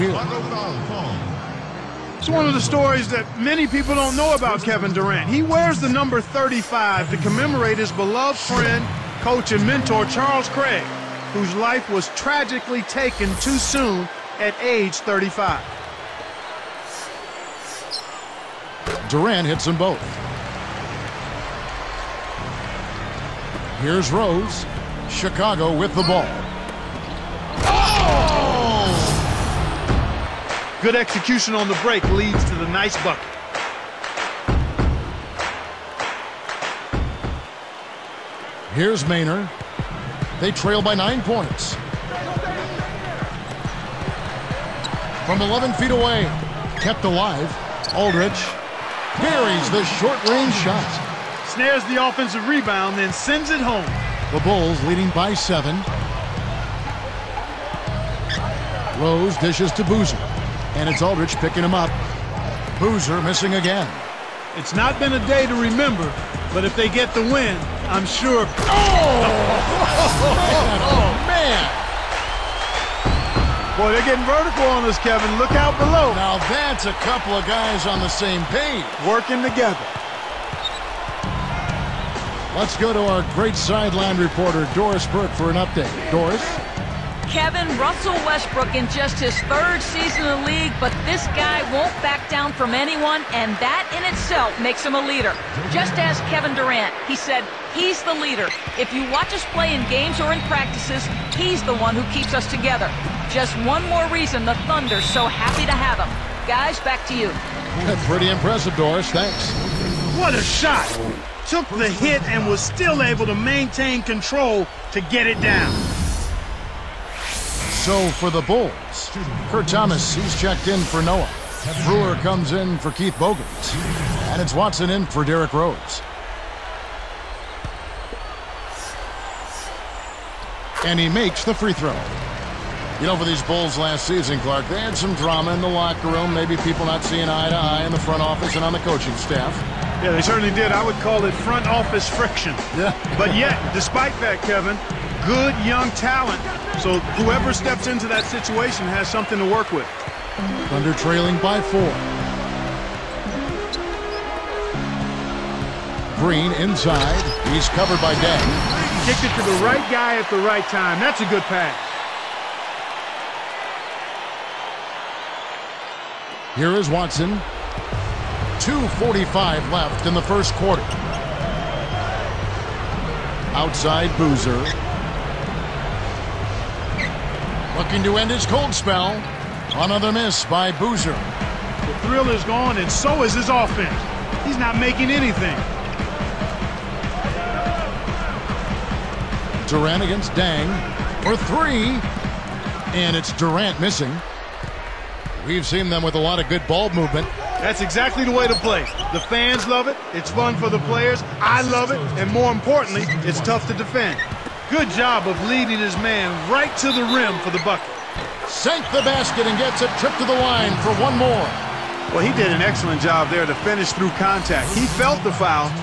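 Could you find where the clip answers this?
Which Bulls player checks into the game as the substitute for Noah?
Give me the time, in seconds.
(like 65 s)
119 s.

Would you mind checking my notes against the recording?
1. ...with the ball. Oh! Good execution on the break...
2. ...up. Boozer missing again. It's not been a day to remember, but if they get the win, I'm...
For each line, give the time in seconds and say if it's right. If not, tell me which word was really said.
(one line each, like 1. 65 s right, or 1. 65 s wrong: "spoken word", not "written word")
1. 25 s right
2. 61 s right.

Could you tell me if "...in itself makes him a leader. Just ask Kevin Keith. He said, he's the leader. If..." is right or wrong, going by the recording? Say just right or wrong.
wrong.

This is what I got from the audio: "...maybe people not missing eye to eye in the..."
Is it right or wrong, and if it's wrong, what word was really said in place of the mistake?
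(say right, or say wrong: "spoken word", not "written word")
wrong: "seeing", not "missing".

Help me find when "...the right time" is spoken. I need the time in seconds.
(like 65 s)
160 s.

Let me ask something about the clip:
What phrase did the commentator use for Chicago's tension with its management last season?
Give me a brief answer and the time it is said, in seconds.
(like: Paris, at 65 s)
front office friction, at 141 s.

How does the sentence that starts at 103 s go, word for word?
Just one more reason the Thunder's so happy to have him.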